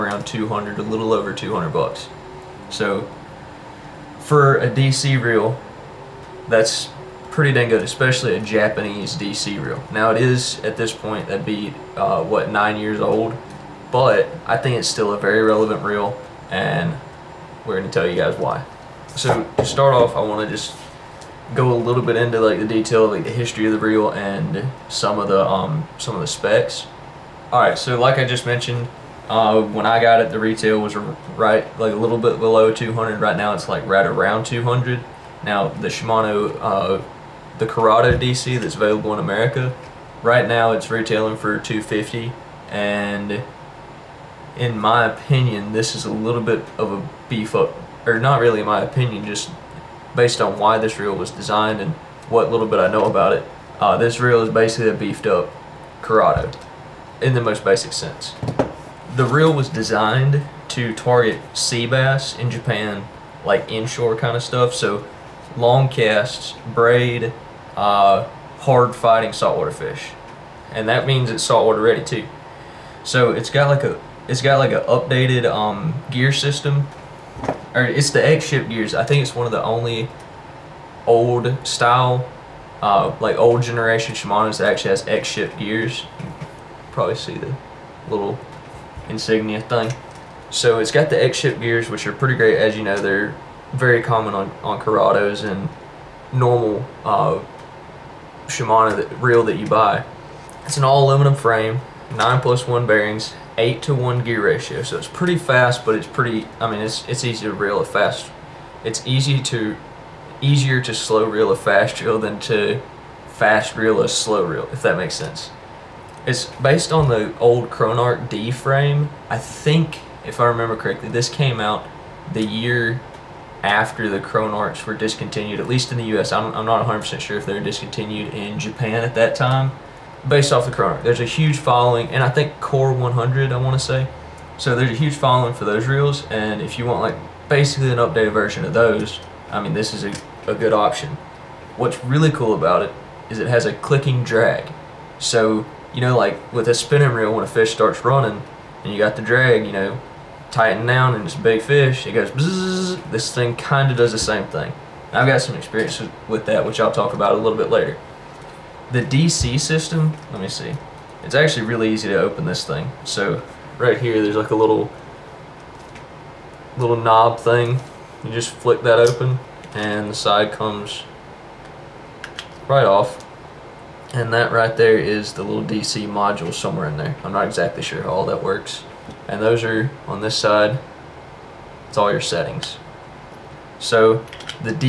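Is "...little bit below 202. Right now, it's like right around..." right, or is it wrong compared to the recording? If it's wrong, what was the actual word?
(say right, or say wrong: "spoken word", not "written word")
wrong: "200", not "202".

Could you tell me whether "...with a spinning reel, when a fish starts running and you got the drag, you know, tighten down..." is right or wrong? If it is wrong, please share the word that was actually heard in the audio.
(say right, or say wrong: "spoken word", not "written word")
right.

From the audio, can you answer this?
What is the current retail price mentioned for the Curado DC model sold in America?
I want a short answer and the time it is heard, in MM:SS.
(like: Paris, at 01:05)
$250, at 00:41.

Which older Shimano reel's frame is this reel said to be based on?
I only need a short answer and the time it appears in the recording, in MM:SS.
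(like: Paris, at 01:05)
Chronarch D, at 01:57.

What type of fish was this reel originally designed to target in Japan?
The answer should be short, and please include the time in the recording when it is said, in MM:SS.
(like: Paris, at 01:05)
sea bass, at 01:01.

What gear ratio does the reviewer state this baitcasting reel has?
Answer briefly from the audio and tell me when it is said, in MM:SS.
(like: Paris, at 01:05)
8 to 1, at 01:43.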